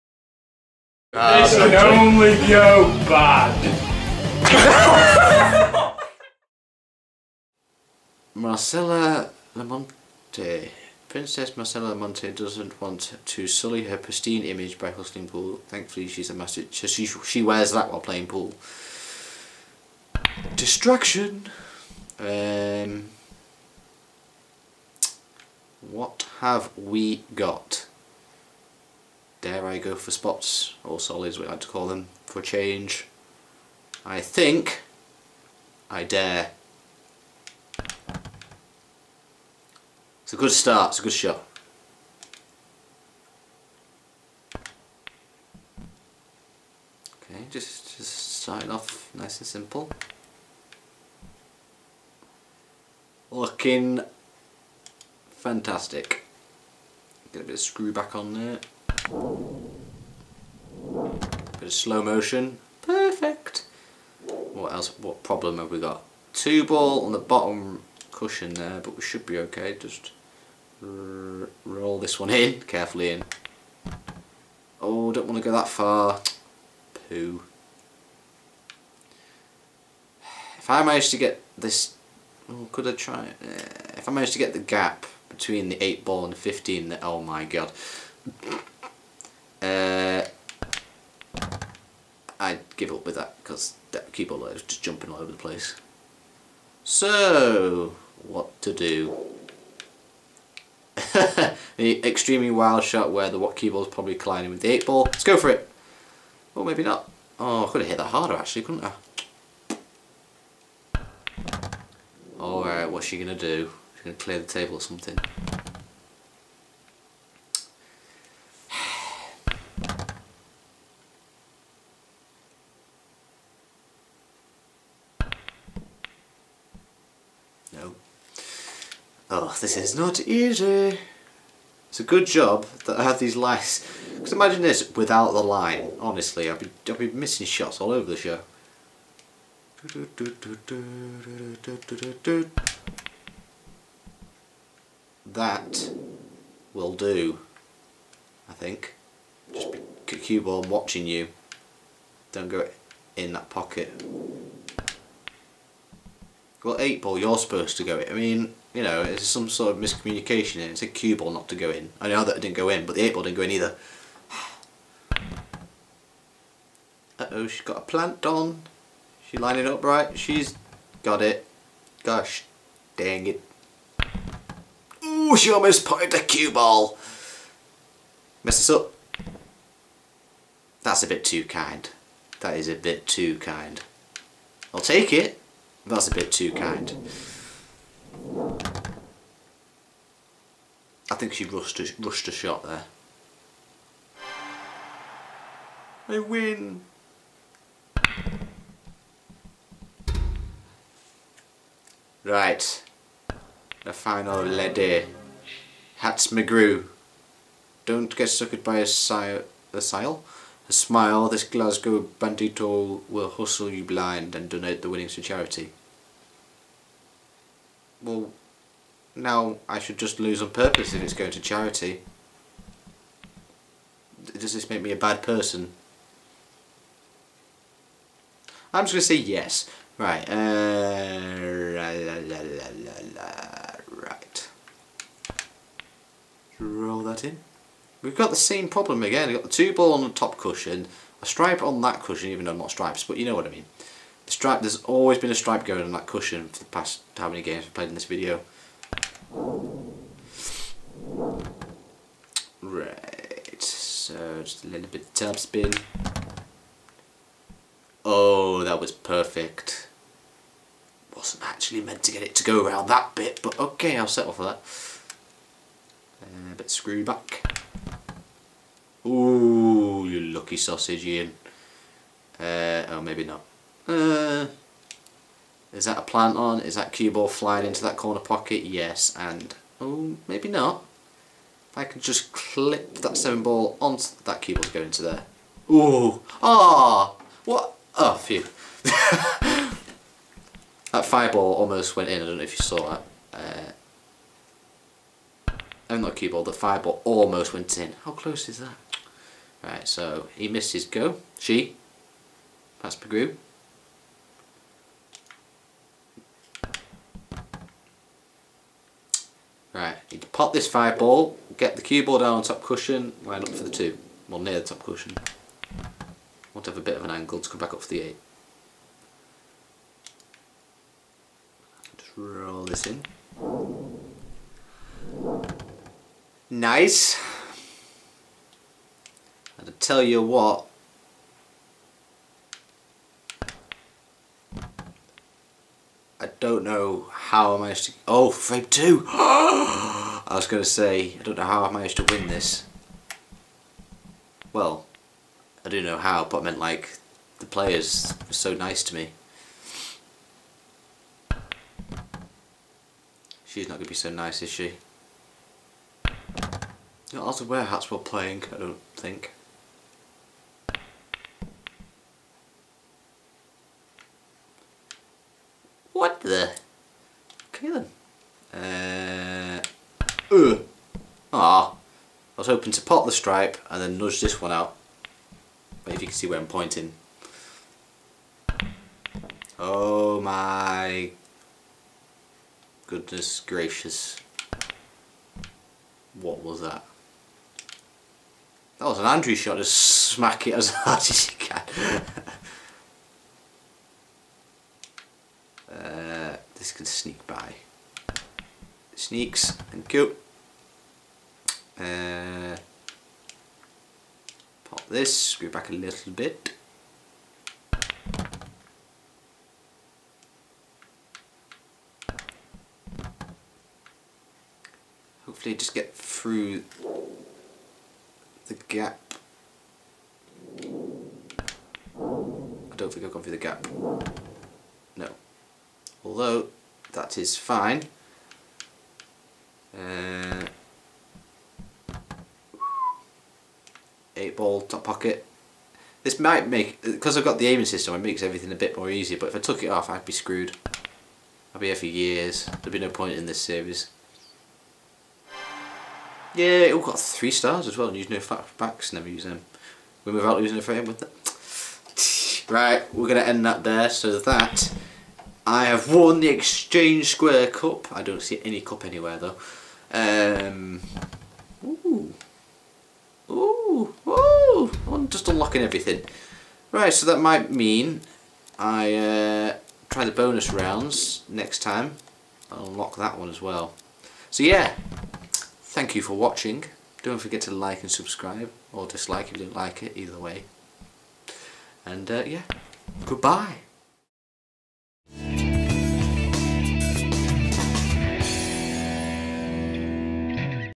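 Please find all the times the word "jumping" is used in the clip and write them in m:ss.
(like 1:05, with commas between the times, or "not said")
1:34.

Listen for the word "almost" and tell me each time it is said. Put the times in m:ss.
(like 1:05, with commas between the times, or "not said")
2:55, 4:51, 4:57.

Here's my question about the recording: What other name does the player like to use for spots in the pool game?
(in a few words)
Solids.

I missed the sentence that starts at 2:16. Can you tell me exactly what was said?
Honestly, I'd be, I'd be missing shots all over the show.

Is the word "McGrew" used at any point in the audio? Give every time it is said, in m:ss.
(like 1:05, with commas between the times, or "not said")
3:26, 5:02.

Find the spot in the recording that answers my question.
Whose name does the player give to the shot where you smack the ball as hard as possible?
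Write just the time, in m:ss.
6:29.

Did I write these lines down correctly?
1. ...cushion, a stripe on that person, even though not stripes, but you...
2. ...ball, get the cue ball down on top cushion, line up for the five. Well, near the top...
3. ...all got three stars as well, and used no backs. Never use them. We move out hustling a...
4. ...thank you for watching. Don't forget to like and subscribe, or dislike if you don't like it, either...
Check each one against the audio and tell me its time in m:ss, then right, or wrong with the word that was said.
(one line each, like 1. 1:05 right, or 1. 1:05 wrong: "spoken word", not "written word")
1. 4:00 wrong: "cushion", not "person"
2. 5:10 wrong: "two", not "five"
3. 7:26 wrong: "losing", not "hustling"
4. 7:55 right.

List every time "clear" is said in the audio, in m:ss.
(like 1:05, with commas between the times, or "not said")
1:54.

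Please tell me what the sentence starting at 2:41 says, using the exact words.
I know that it didn't go in, but the eight ball didn't go in either.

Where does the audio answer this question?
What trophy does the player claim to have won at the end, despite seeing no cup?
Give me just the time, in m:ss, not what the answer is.
7:36.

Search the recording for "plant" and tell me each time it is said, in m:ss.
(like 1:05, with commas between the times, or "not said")
2:47, 4:36.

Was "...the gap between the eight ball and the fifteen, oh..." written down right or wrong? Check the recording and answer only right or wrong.
right.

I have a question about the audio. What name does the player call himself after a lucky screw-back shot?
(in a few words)
Iain.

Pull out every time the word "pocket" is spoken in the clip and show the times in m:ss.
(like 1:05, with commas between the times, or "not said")
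2:33, 4:38, 7:14.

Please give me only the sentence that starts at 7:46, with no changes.
Right, so that might mean I uh, try the bonus rounds next time.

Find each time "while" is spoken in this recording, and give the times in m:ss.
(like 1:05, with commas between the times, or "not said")
0:17, 5:57.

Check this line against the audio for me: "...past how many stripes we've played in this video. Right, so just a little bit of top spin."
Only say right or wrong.
wrong.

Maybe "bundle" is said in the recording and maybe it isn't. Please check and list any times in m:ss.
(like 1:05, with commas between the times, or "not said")
not said.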